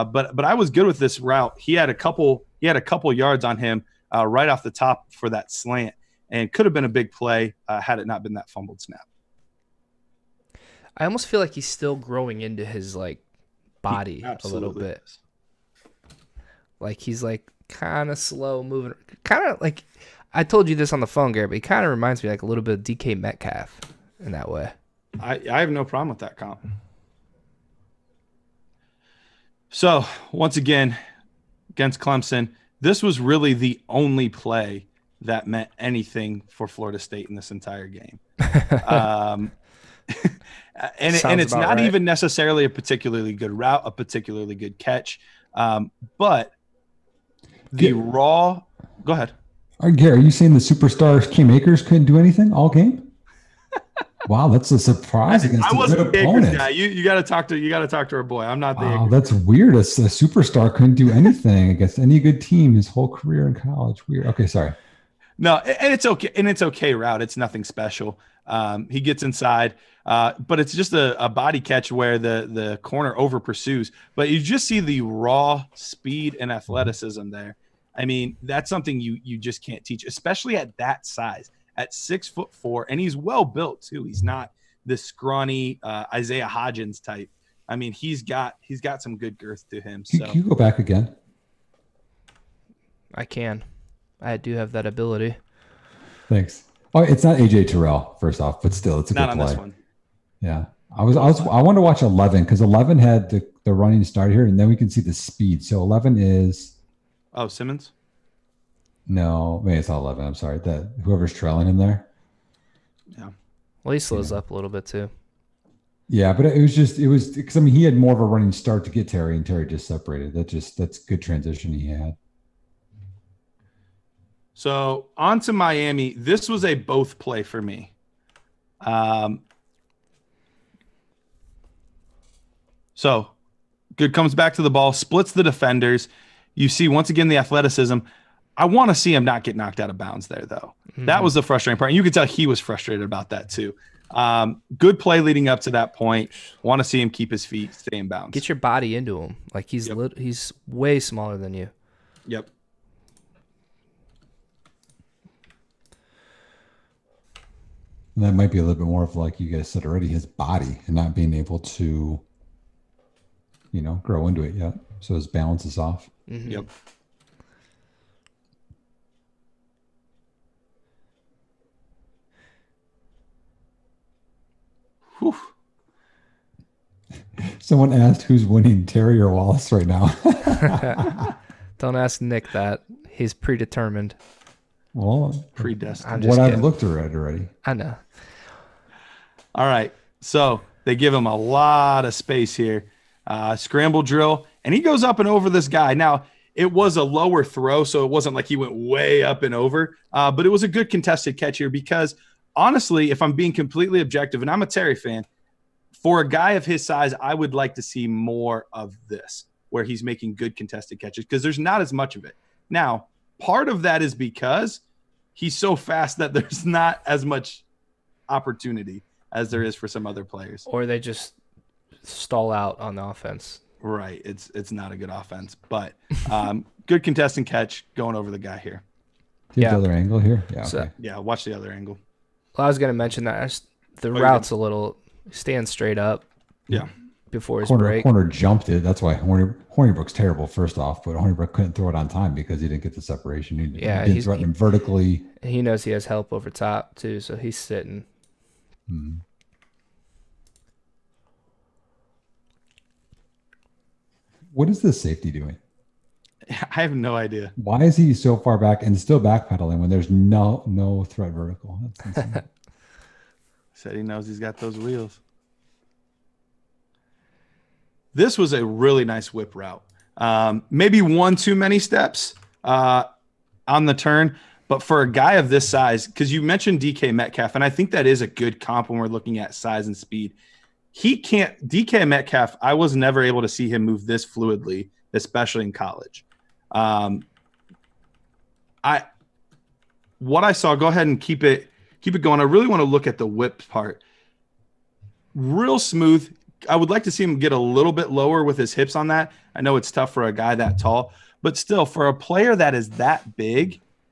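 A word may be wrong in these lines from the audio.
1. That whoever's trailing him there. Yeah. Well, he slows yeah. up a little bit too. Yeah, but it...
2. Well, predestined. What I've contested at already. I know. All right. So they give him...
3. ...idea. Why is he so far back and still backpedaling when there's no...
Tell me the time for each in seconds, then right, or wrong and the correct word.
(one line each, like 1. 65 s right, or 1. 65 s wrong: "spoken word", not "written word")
1. 110 s right
2. 184 s wrong: "looked", not "contested"
3. 257 s right.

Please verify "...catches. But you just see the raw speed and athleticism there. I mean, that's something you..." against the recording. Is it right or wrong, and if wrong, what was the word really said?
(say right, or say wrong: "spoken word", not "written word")
wrong: "pursues", not "catches".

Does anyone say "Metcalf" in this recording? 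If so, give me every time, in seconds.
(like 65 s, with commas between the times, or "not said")
23 s, 277 s, 282 s.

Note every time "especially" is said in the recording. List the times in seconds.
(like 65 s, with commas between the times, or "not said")
80 s, 285 s.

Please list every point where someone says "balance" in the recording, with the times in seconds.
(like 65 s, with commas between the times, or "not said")
165 s.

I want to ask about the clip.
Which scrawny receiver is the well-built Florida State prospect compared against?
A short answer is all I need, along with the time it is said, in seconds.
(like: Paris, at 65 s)
Isaiah Hodgins, at 86 s.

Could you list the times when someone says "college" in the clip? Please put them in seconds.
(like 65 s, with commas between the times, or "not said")
63 s, 285 s.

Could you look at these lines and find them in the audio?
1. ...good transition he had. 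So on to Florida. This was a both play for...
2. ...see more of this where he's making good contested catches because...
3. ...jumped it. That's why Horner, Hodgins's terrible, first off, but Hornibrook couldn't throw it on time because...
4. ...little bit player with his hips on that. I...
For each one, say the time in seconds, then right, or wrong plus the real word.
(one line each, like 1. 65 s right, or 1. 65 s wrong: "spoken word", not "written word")
1. 120 s wrong: "Miami", not "Florida"
2. 207 s right
3. 238 s wrong: "Hornibrook", not "Hodgins"
4. 297 s wrong: "lower", not "player".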